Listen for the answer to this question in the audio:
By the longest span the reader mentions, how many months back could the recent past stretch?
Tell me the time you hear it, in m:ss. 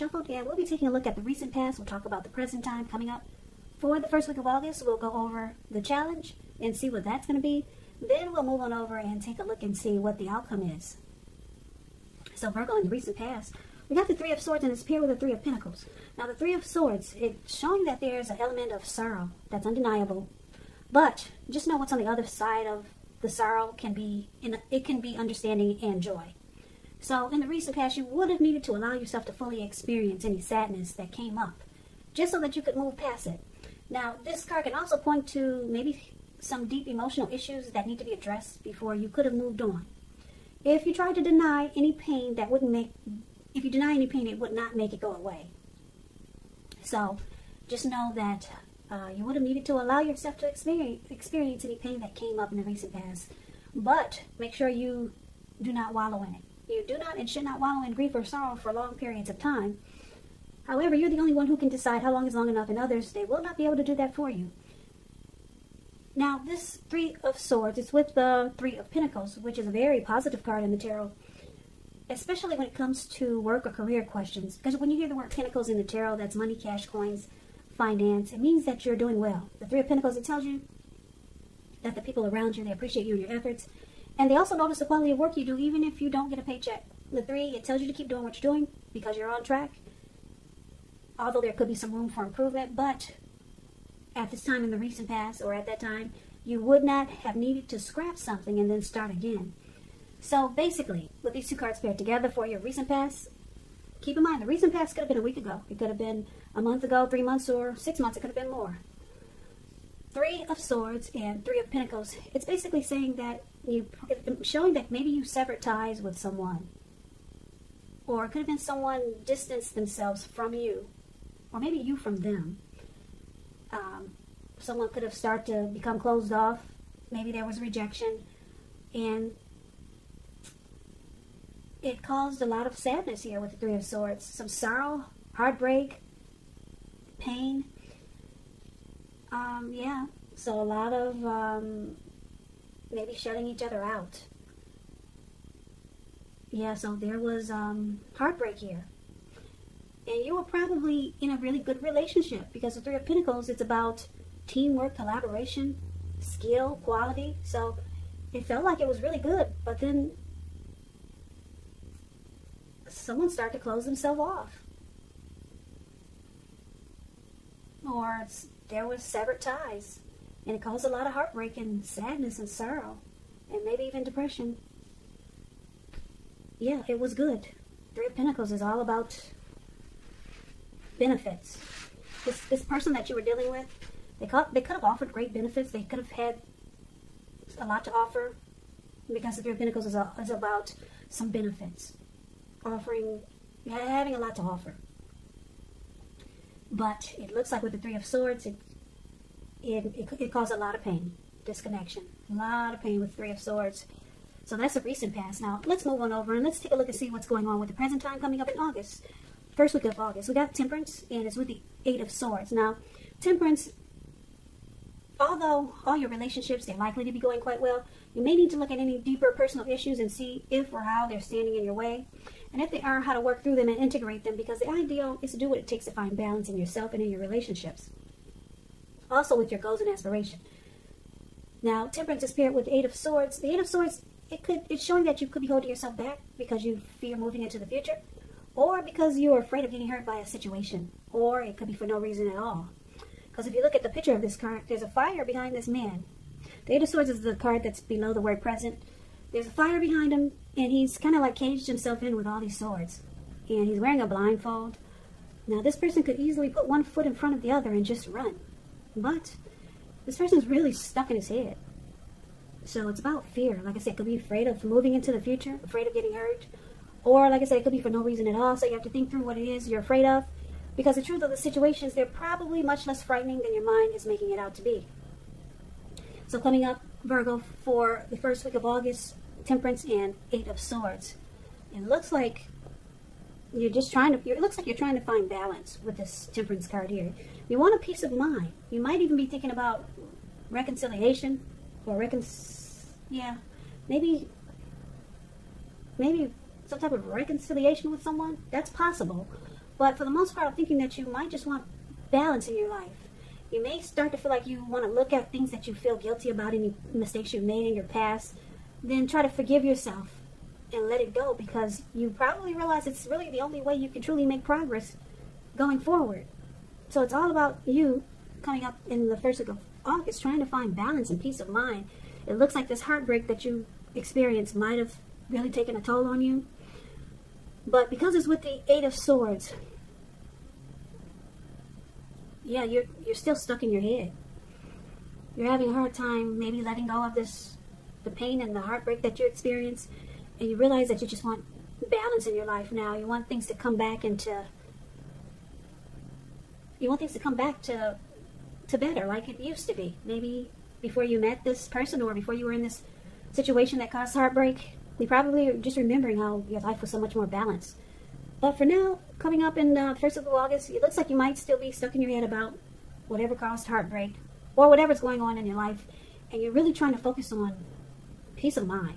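1:47.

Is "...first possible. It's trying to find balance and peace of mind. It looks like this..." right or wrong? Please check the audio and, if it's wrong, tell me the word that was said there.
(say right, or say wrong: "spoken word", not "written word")
wrong: "circle", not "possible".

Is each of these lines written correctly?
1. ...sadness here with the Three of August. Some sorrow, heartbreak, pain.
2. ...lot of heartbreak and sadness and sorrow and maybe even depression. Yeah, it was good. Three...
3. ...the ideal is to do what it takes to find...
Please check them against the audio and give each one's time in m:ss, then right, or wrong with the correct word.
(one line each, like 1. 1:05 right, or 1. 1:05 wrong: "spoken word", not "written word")
1. 2:12 wrong: "Swords", not "August"
2. 2:50 right
3. 3:44 right.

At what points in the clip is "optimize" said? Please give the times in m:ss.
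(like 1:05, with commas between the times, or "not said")
not said.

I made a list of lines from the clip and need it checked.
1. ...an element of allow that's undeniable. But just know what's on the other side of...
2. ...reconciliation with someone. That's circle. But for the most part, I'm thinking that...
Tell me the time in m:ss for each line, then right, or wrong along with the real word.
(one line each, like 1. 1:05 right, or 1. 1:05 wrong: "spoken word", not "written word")
1. 0:18 wrong: "sorrow", not "allow"
2. 4:57 wrong: "possible", not "circle".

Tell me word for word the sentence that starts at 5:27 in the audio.
But because it's with the Eight of Swords, yeah, you're, you're still stuck in your head.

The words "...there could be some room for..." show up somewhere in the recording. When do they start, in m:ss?
1:31.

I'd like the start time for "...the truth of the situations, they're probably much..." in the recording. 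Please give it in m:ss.
4:30.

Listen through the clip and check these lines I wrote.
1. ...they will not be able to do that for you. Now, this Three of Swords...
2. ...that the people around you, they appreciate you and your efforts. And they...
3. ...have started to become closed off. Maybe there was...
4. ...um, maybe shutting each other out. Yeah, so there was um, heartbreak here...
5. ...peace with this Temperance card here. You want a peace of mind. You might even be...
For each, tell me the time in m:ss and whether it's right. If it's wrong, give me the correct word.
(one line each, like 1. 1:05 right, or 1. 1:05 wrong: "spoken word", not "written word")
1. 1:03 right
2. 1:21 right
3. 2:05 right
4. 2:21 right
5. 4:45 wrong: "balance", not "peace".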